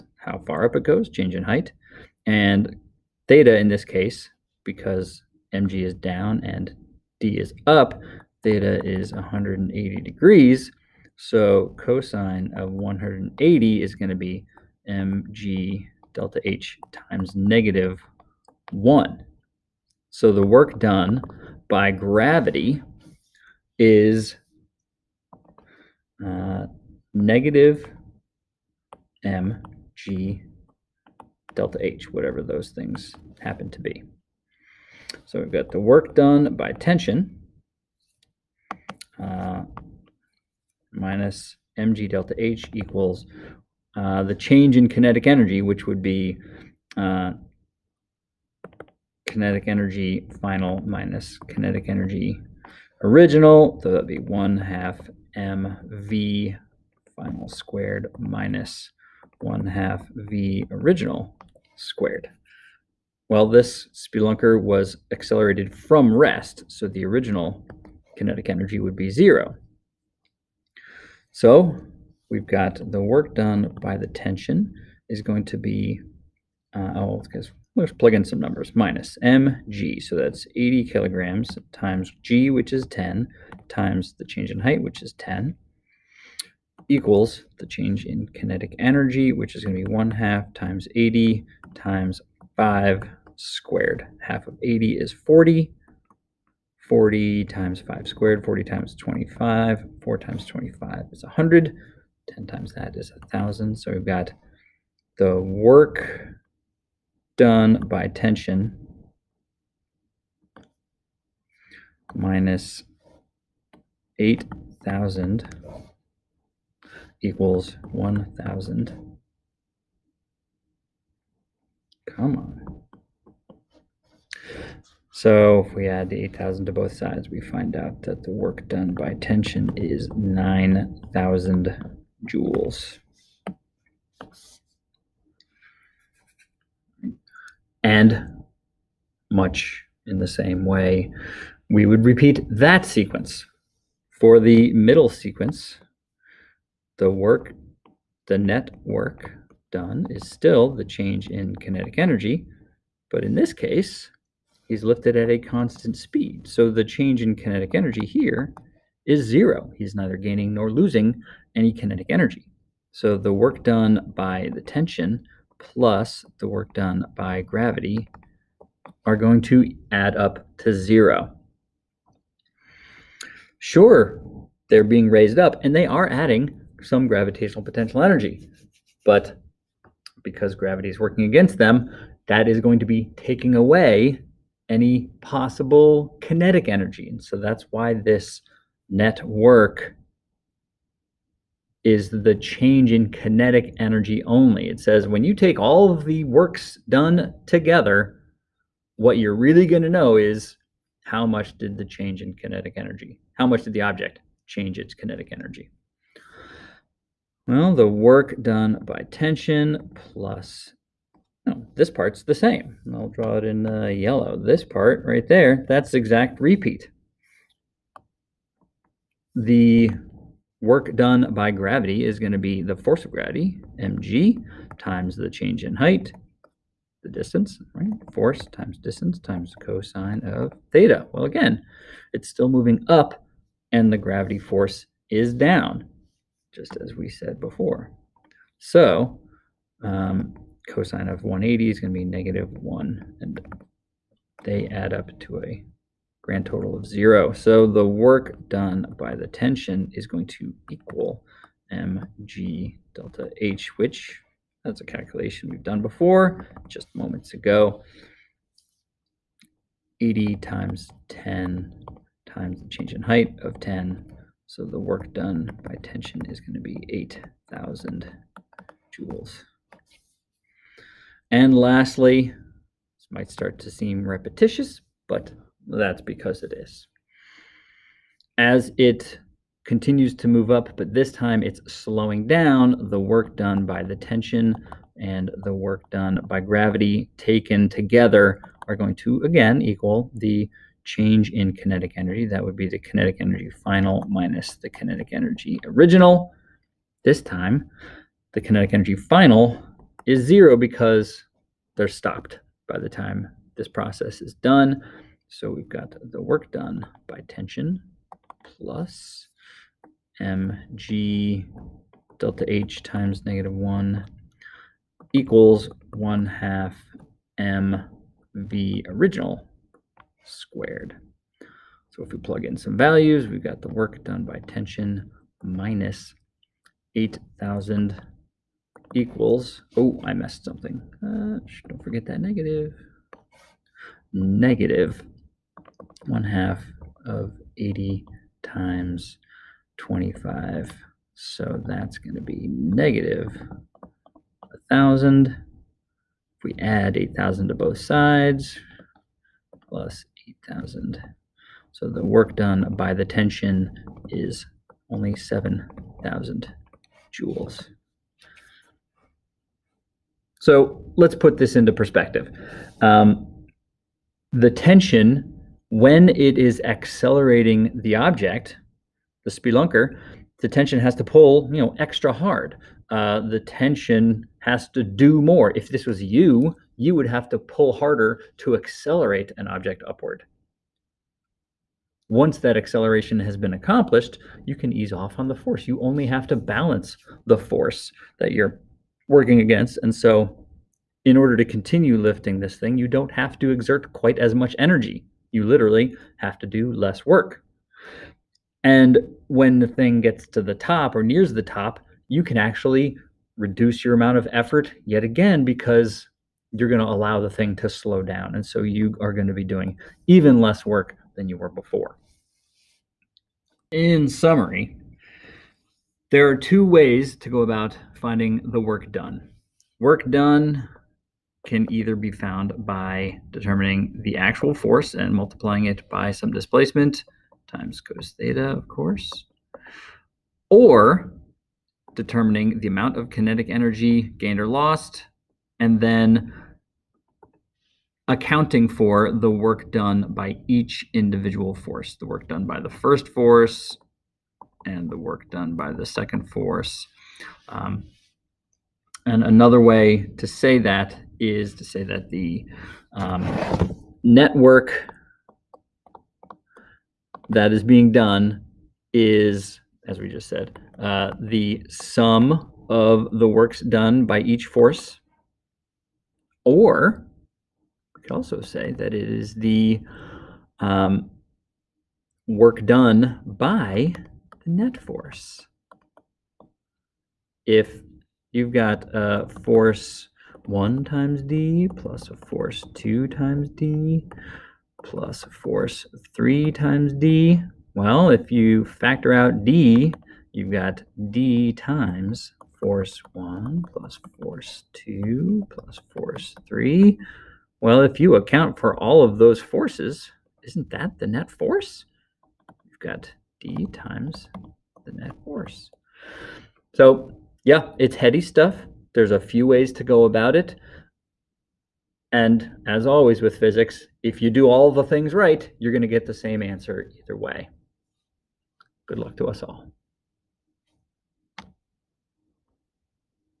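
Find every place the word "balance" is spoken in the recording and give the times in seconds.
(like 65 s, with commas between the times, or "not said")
386 s.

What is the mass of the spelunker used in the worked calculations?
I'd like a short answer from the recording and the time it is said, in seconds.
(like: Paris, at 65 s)
80 kilograms, at 80 s.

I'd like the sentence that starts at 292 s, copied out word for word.
That would be the kinetic energy final minus the kinetic energy original.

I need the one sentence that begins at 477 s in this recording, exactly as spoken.
If you've got a force 1 times d plus a force 2 times d plus a force 3 times d.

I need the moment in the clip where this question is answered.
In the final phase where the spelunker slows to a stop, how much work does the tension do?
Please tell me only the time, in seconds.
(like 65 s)
355 s.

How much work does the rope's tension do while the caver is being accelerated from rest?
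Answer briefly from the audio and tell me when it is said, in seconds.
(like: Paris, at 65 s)
9,000 joules, at 130 s.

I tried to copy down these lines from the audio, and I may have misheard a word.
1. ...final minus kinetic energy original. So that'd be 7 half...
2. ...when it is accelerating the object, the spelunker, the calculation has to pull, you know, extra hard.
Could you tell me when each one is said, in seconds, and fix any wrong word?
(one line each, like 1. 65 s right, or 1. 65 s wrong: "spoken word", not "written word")
1. 50 s wrong: "1", not "7"
2. 365 s wrong: "tension", not "calculation".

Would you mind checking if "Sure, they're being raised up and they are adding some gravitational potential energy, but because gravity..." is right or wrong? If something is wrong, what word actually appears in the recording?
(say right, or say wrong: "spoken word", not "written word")
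right.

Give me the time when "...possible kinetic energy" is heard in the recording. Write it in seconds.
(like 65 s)
185 s.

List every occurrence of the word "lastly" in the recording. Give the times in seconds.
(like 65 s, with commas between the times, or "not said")
271 s.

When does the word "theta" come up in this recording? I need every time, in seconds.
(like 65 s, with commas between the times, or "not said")
3 s, 8 s, 230 s, 428 s.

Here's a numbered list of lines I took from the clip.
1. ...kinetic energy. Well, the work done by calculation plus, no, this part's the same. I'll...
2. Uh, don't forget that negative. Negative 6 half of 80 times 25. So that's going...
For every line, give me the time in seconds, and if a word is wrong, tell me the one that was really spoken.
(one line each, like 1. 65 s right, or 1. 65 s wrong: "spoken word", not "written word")
1. 204 s wrong: "tension", not "calculation"
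2. 331 s wrong: "1", not "6".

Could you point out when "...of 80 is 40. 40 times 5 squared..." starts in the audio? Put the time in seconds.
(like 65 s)
94 s.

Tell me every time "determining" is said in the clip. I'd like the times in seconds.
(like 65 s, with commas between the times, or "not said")
423 s, 431 s.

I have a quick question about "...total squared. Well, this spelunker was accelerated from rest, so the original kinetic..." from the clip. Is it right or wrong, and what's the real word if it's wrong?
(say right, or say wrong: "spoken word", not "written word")
wrong: "original", not "total".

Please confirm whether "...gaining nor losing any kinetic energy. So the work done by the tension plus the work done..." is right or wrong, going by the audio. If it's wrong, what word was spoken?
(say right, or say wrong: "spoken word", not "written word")
right.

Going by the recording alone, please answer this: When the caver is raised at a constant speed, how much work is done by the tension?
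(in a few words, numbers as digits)
8,000 joules.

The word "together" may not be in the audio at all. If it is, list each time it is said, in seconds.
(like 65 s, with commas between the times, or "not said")
197 s, 287 s.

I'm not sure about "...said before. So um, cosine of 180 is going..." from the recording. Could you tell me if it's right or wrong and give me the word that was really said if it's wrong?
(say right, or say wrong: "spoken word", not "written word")
right.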